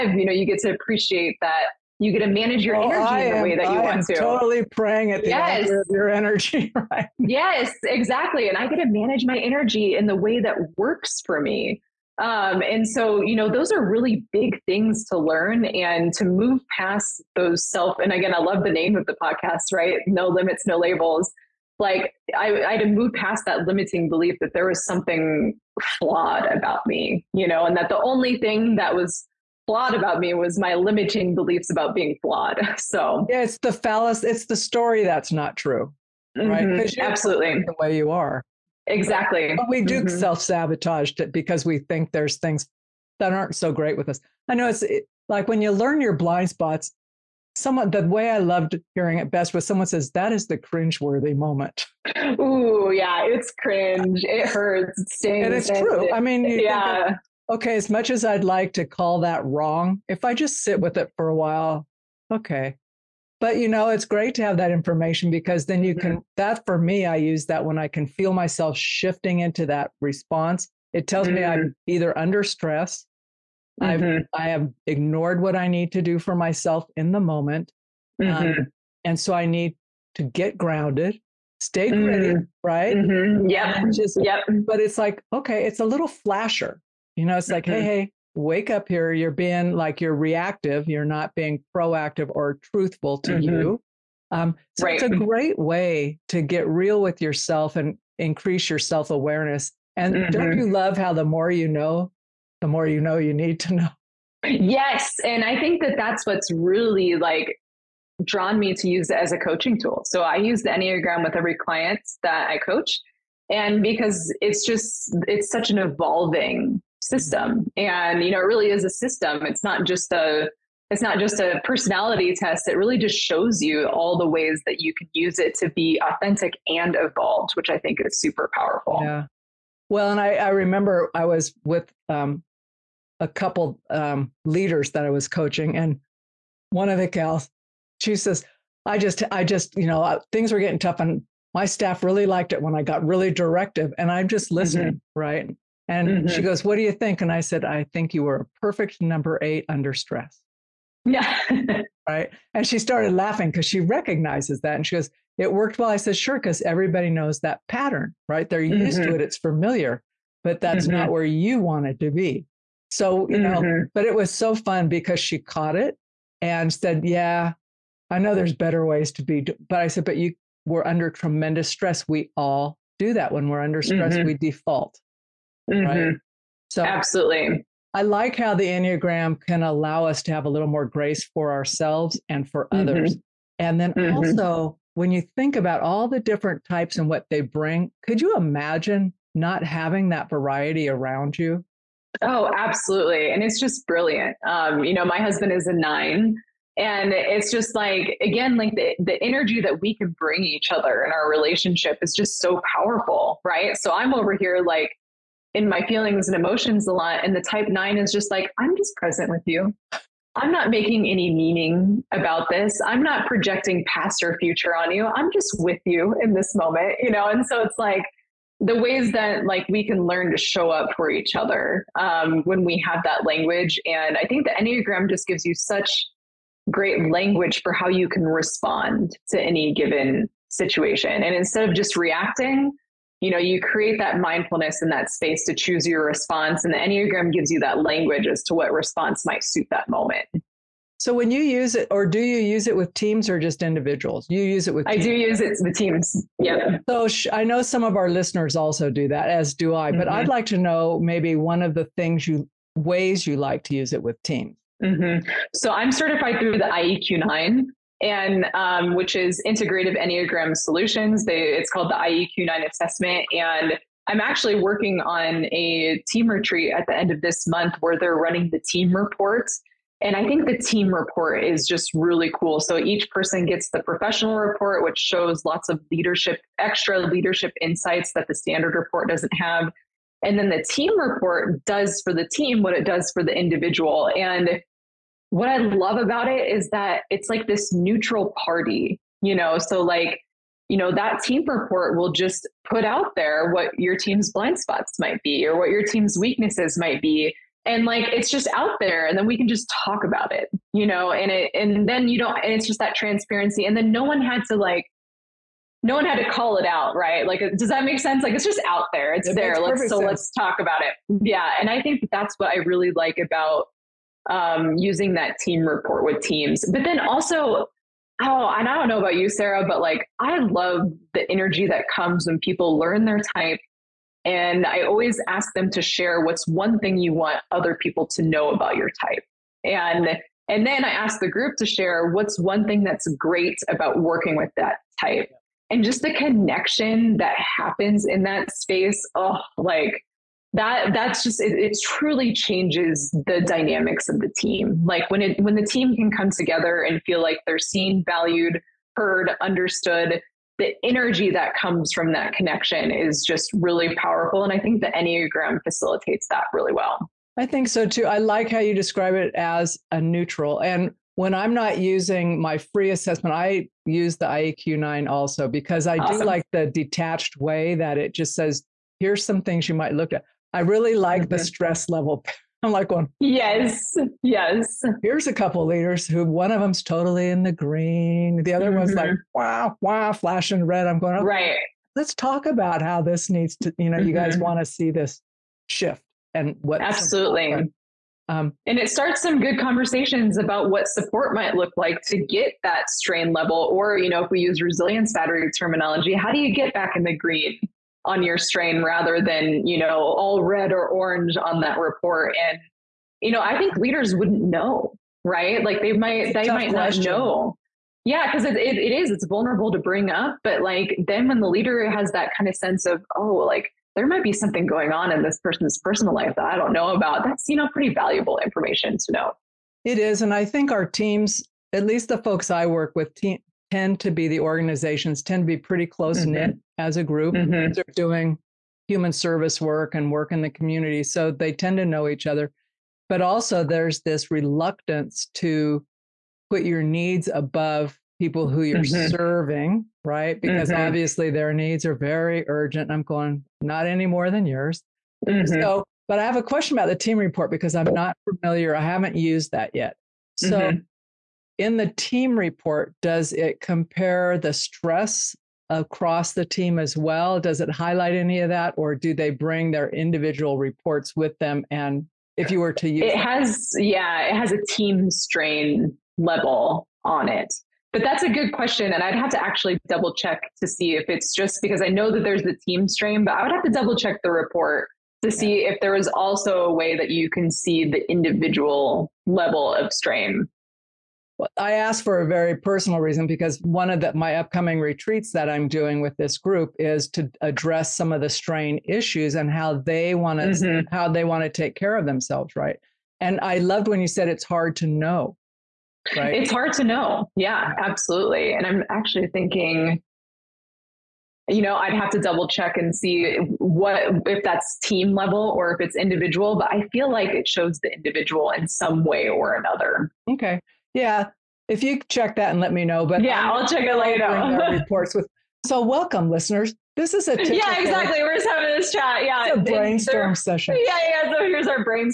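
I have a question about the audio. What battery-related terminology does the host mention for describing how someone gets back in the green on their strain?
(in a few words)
resilience battery.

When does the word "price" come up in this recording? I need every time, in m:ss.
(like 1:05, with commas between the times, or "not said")
not said.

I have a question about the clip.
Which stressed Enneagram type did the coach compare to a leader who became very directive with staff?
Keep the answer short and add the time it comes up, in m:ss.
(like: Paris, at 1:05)
8, at 2:29.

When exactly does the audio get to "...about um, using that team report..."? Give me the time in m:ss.
5:13.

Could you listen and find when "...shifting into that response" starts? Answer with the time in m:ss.
1:08.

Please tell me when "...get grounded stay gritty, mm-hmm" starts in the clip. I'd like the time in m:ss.
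1:20.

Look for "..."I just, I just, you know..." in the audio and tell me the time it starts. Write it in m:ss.
2:18.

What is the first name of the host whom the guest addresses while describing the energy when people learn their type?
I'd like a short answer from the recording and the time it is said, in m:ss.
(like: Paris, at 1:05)
Sarah, at 5:19.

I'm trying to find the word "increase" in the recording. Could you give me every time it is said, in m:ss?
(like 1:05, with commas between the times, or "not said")
1:38.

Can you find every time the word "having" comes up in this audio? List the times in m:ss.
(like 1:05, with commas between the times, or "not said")
3:09, 8:38.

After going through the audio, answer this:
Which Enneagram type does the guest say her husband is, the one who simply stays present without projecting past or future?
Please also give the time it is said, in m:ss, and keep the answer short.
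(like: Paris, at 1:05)
9, at 3:15.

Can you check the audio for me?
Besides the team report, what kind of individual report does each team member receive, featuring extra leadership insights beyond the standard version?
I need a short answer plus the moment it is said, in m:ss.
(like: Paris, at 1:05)
professional report, at 4:33.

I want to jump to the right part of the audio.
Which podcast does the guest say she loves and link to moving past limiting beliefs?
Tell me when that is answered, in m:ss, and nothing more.
0:20.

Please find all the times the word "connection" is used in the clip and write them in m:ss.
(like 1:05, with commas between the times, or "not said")
5:36, 5:52.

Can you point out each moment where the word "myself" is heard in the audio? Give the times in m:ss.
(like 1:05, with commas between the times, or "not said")
1:08, 1:16.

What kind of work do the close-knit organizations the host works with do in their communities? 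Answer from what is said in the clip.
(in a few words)
human service work.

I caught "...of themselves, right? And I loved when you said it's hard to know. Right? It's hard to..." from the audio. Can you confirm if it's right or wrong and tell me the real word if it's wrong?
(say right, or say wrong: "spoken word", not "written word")
right.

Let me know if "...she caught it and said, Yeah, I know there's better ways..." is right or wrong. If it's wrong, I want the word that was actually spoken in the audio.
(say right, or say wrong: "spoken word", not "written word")
right.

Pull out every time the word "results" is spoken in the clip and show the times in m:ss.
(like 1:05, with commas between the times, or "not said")
not said.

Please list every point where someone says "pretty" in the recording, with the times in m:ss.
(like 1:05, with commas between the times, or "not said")
6:57, 7:05.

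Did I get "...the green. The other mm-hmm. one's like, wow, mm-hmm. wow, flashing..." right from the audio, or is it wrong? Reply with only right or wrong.
right.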